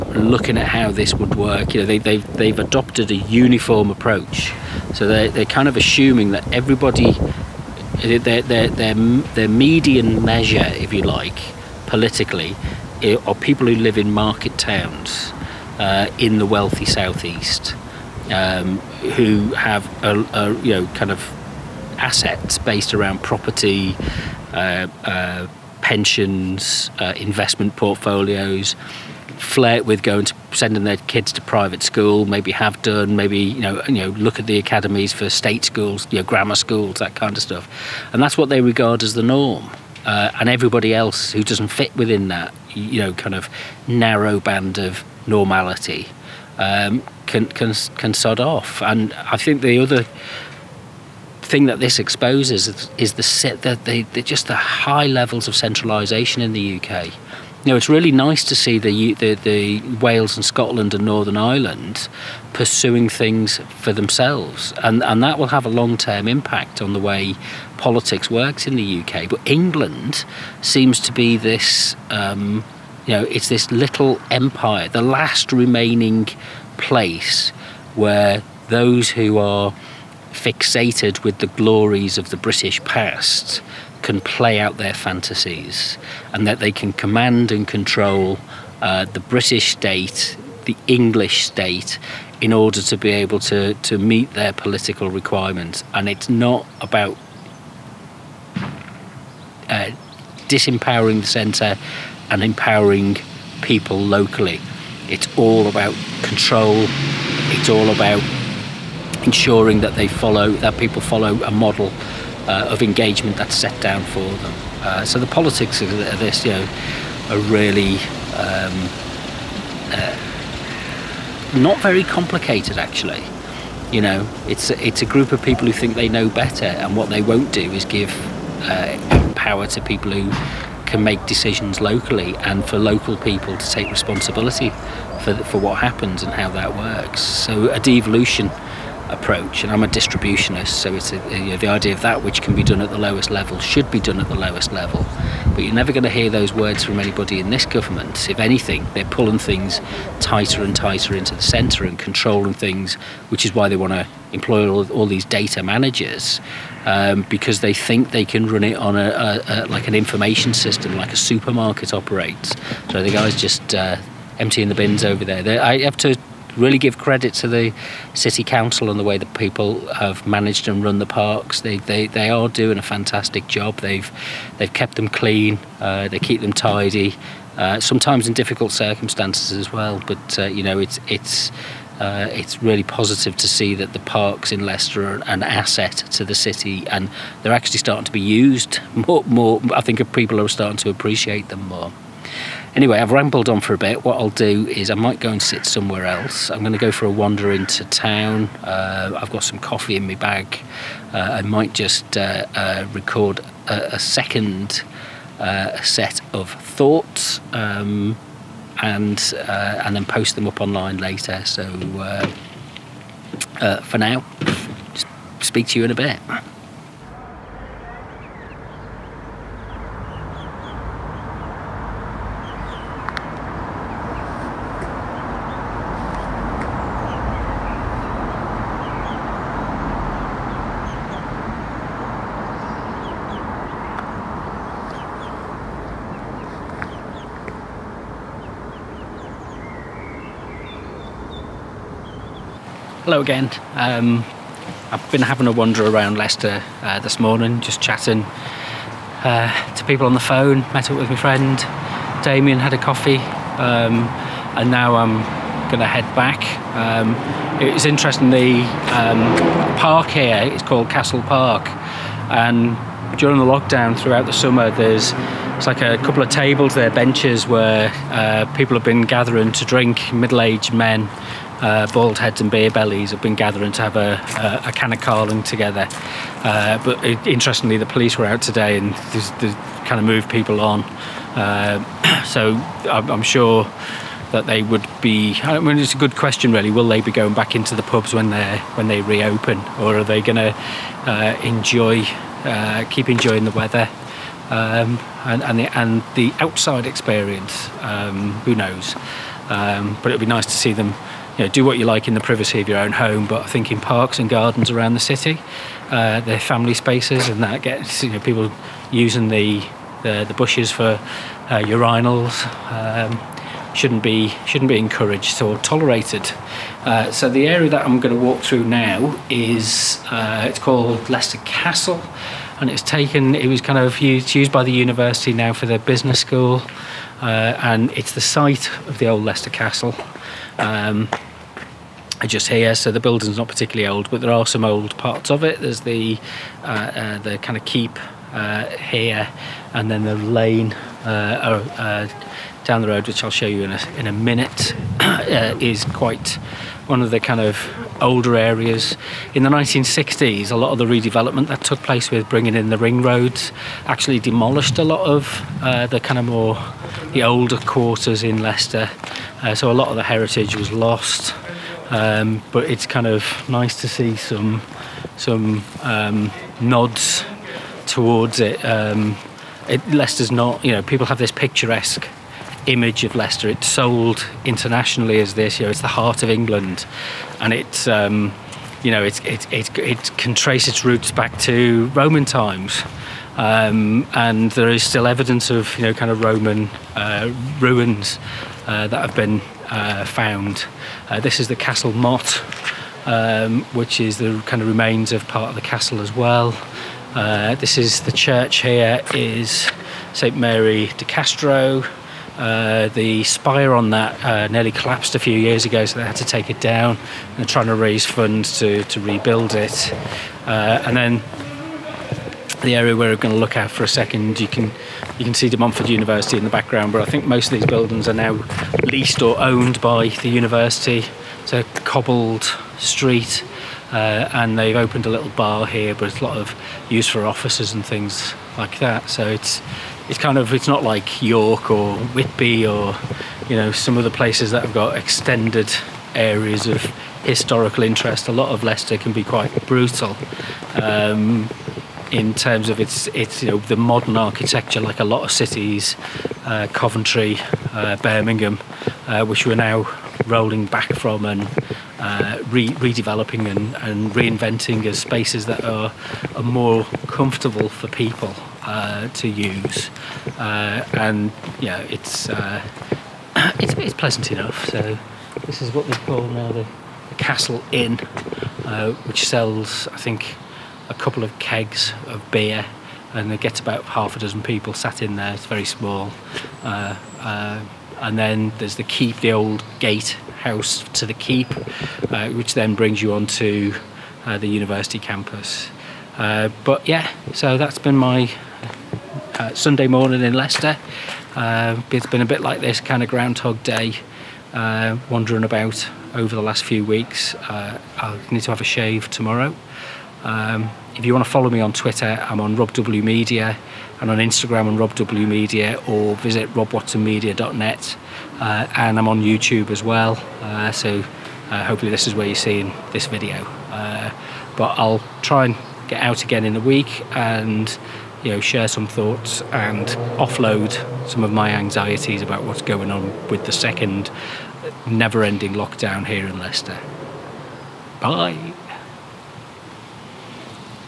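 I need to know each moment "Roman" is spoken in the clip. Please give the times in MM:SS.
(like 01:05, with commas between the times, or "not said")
06:21, 06:26.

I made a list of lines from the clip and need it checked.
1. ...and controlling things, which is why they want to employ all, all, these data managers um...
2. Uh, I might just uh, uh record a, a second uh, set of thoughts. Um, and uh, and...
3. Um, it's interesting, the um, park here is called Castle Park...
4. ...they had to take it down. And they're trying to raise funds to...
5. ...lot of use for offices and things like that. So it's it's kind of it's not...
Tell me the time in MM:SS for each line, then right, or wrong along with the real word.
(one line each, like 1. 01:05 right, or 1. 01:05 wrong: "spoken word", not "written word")
1. 02:31 right
2. 03:21 right
3. 04:16 right
4. 06:46 right
5. 07:06 right.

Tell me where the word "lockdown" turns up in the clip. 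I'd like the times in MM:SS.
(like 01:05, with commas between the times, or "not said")
04:23, 08:45.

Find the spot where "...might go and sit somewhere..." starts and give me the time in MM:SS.
03:14.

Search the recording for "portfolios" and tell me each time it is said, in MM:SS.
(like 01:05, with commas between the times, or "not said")
00:27.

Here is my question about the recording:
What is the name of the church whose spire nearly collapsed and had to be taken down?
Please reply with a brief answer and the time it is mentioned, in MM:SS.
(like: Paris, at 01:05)
St Mary de Castro, at 06:40.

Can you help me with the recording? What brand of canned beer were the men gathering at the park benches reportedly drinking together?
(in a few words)
Carling.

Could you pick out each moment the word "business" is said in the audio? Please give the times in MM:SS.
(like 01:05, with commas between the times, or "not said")
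05:25.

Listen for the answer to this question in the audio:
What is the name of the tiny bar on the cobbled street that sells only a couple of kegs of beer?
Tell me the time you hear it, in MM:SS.
07:47.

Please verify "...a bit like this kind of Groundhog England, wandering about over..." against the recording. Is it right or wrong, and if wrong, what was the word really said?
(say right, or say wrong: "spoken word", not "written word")
wrong: "Day", not "England".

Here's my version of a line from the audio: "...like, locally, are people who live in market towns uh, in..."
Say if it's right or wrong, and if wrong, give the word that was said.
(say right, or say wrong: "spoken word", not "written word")
wrong: "politically", not "locally".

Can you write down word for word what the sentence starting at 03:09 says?
More, I think people are starting to appreciate them more.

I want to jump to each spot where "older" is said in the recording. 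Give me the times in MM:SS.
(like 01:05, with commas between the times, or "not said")
05:48, 05:57.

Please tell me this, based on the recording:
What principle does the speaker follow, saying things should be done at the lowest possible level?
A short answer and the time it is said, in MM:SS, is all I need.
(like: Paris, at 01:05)
distributionist, at 02:19.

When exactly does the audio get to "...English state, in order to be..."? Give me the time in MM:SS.
01:30.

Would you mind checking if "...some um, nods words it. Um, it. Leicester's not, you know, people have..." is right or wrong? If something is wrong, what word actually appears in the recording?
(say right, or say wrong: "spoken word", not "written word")
wrong: "towards", not "words".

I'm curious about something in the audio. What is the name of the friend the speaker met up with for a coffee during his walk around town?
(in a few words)
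Damien.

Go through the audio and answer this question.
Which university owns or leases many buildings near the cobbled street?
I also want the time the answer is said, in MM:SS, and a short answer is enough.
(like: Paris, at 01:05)
De Montfort University, at 06:55.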